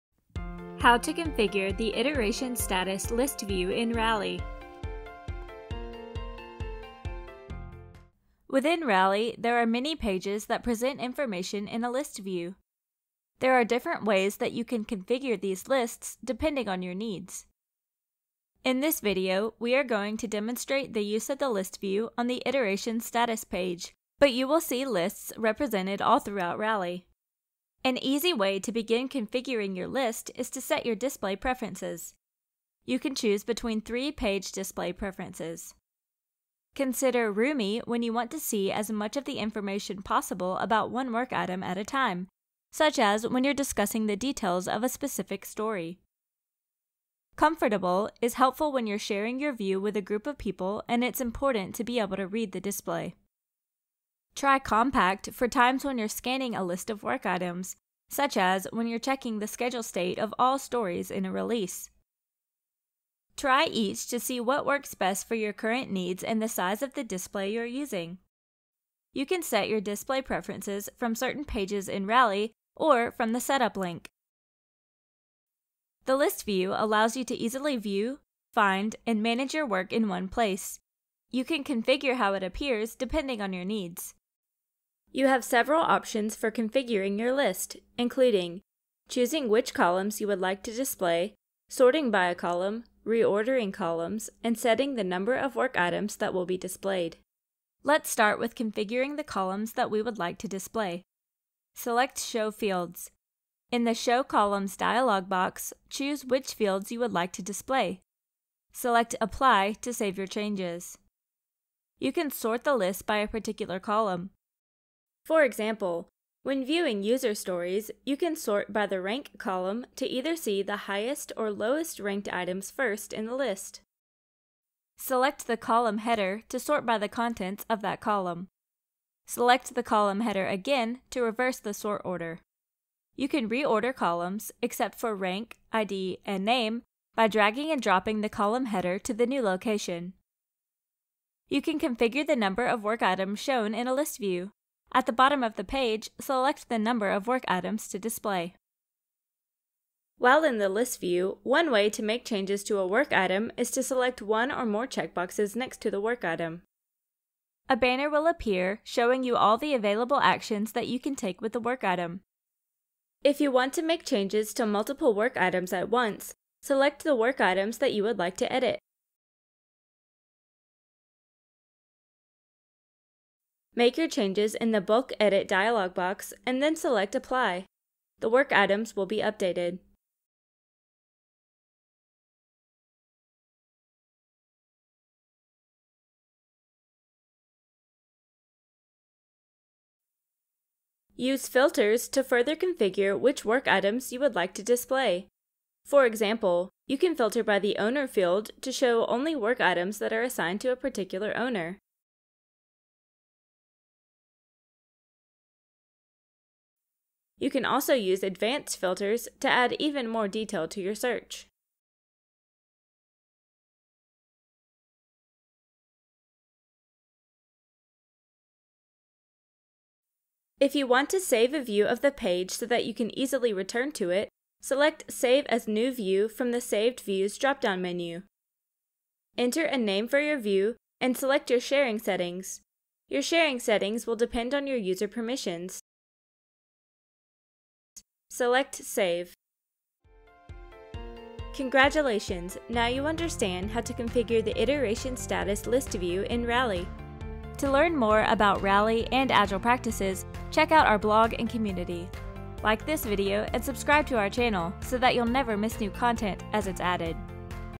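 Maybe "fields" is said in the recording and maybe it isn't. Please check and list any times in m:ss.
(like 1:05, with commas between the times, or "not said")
1:42, 1:46, 3:18.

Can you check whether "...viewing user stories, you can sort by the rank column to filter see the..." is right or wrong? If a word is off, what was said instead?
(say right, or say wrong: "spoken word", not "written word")
wrong: "either", not "filter".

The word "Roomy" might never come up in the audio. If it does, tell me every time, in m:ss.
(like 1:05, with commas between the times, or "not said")
0:37.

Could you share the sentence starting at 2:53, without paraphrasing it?
Make your changes in the Bulk Edit dialog box and then select Apply.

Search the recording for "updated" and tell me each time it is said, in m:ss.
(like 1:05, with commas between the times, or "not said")
2:59.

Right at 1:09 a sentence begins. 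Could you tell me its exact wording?
You can set your display preferences from certain pages in Rally or from the Setup link.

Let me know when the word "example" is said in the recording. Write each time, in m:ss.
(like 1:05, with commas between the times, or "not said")
1:55, 3:16.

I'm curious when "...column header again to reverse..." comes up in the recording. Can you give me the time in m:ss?
2:09.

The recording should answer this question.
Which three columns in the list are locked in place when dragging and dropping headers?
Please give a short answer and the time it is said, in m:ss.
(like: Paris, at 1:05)
Rank, ID, and name, at 2:15.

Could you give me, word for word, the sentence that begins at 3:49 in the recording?
Enter a name for your view and select your sharing settings.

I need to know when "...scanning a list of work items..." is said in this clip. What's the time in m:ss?
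0:56.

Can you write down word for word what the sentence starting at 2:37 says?
A banner will appear showing you all the available actions that you can take with the work item.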